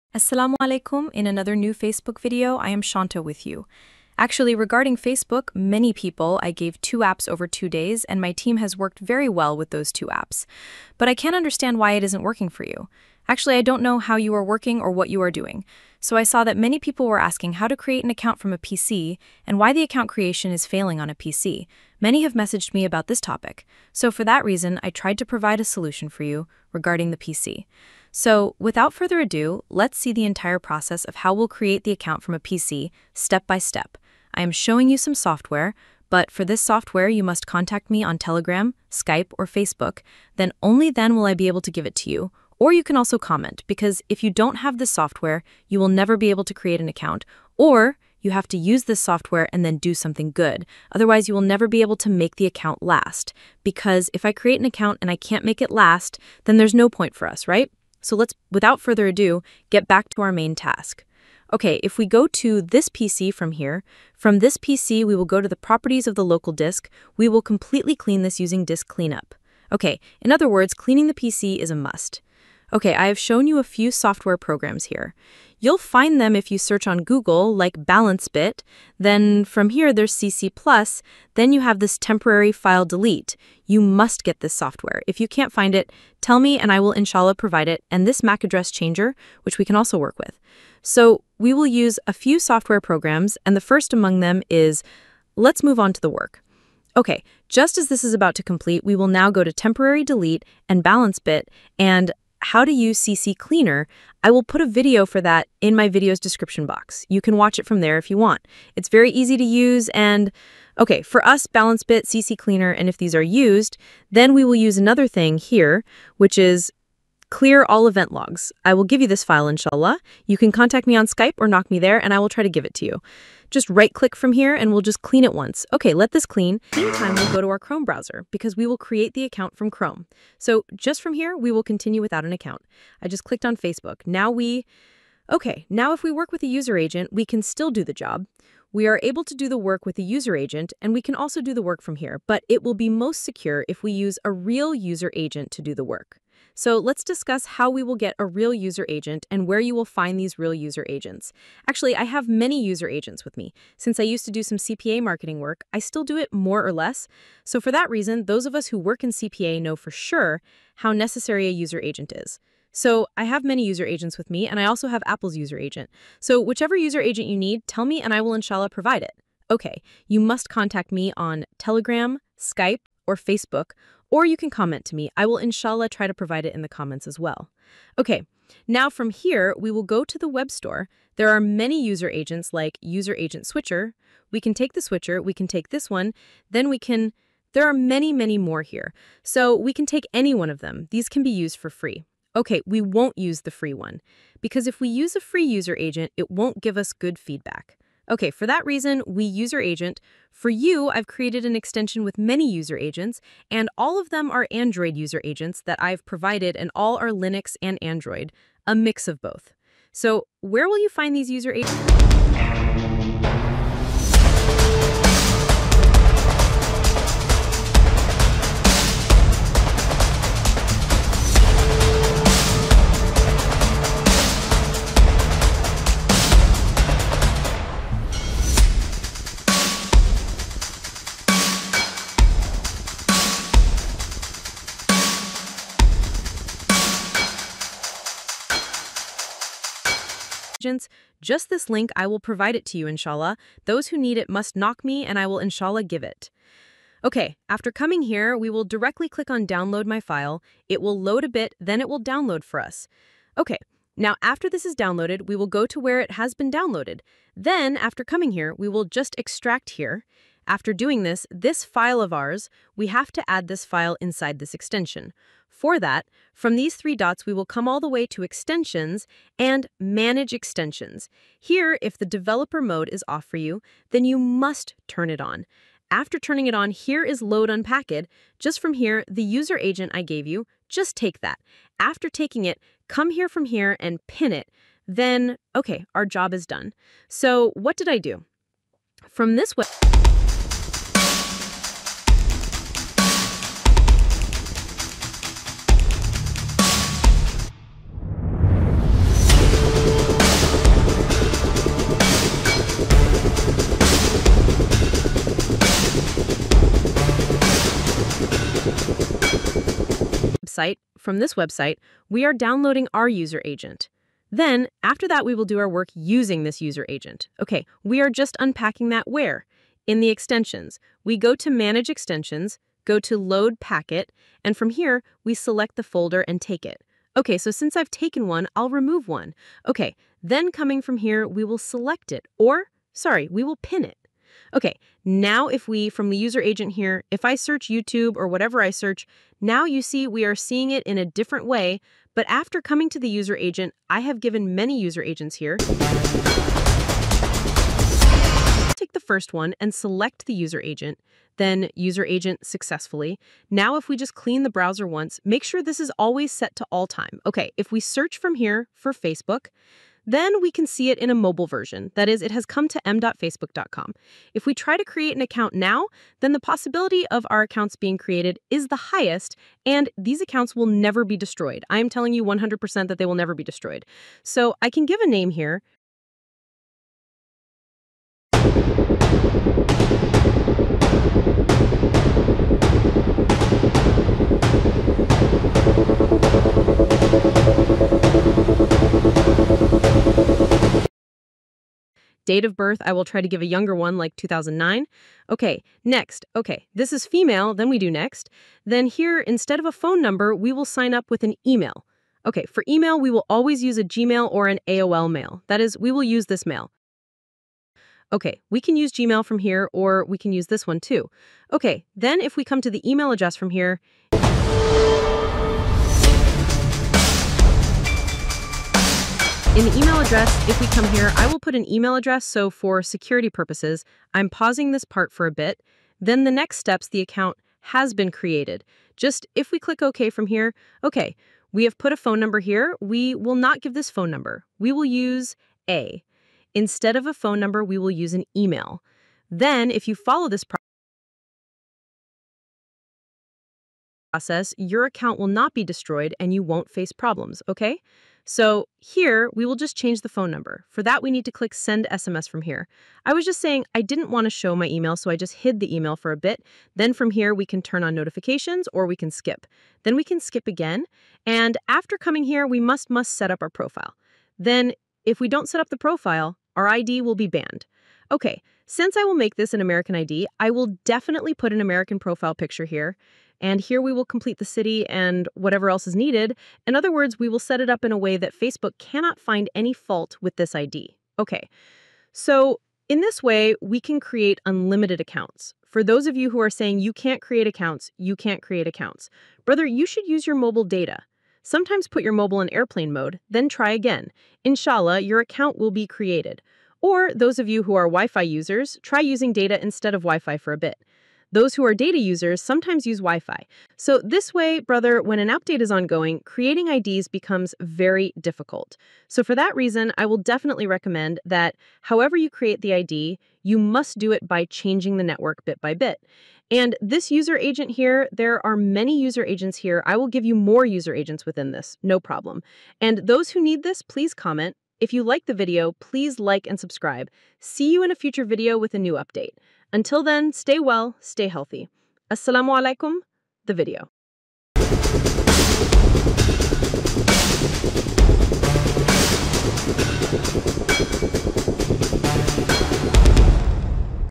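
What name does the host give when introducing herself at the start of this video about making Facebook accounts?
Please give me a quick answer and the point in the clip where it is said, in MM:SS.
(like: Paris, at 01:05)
Shanta, at 00:02.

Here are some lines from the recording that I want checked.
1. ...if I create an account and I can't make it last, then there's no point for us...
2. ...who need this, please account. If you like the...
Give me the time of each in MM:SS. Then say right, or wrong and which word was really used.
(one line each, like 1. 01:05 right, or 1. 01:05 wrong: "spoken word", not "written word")
1. 00:54 right
2. 08:43 wrong: "comment", not "account".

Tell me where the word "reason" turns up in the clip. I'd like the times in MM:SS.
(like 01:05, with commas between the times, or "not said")
00:24, 02:37, 03:18, 08:29.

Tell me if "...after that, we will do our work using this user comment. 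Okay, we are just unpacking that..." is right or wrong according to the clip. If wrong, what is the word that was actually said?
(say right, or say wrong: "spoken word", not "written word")
wrong: "agent", not "comment".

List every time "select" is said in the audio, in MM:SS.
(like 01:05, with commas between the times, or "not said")
05:25, 05:31, 05:49.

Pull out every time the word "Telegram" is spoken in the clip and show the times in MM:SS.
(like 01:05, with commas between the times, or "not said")
00:38, 02:51.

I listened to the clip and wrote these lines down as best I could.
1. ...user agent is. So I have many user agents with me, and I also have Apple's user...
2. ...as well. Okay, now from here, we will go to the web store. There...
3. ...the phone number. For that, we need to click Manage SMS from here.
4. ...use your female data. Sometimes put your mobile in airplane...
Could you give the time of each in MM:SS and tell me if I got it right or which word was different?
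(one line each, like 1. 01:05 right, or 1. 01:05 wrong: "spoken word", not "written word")
1. 02:41 right
2. 02:57 right
3. 07:30 wrong: "Send", not "Manage"
4. 08:10 wrong: "mobile", not "female".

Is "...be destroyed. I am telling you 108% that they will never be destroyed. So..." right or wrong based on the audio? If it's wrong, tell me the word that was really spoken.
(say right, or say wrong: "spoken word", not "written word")
wrong: "100", not "108".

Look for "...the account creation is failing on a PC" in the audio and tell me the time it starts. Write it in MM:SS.
00:19.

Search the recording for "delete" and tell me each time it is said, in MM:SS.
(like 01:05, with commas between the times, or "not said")
01:22, 01:40.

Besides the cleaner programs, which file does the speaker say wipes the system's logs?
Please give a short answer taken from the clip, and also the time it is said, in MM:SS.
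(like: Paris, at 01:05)
Clear all event logs, at 01:57.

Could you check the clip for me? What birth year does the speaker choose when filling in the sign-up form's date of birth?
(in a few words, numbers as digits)
2009.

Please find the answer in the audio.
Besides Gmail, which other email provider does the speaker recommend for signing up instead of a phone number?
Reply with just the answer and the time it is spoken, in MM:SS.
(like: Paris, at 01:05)
AOL, at 06:44.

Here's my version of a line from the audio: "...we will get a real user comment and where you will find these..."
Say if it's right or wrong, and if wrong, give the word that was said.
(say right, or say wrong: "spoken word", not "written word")
wrong: "agent", not "comment".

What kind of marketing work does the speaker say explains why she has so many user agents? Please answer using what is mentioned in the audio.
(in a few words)
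CPA marketing.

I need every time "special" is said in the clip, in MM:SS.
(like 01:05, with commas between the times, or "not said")
not said.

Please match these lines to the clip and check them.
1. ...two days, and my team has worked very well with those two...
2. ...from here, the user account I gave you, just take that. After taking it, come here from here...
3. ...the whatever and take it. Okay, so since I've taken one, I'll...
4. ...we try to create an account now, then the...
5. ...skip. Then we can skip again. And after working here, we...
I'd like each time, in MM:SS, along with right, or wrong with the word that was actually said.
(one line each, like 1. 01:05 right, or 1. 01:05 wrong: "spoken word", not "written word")
1. 00:07 right
2. 04:38 wrong: "agent", not "account"
3. 05:25 wrong: "folder", not "whatever"
4. 06:04 right
5. 07:39 wrong: "coming", not "working".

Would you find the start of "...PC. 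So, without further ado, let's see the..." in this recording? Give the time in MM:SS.
00:27.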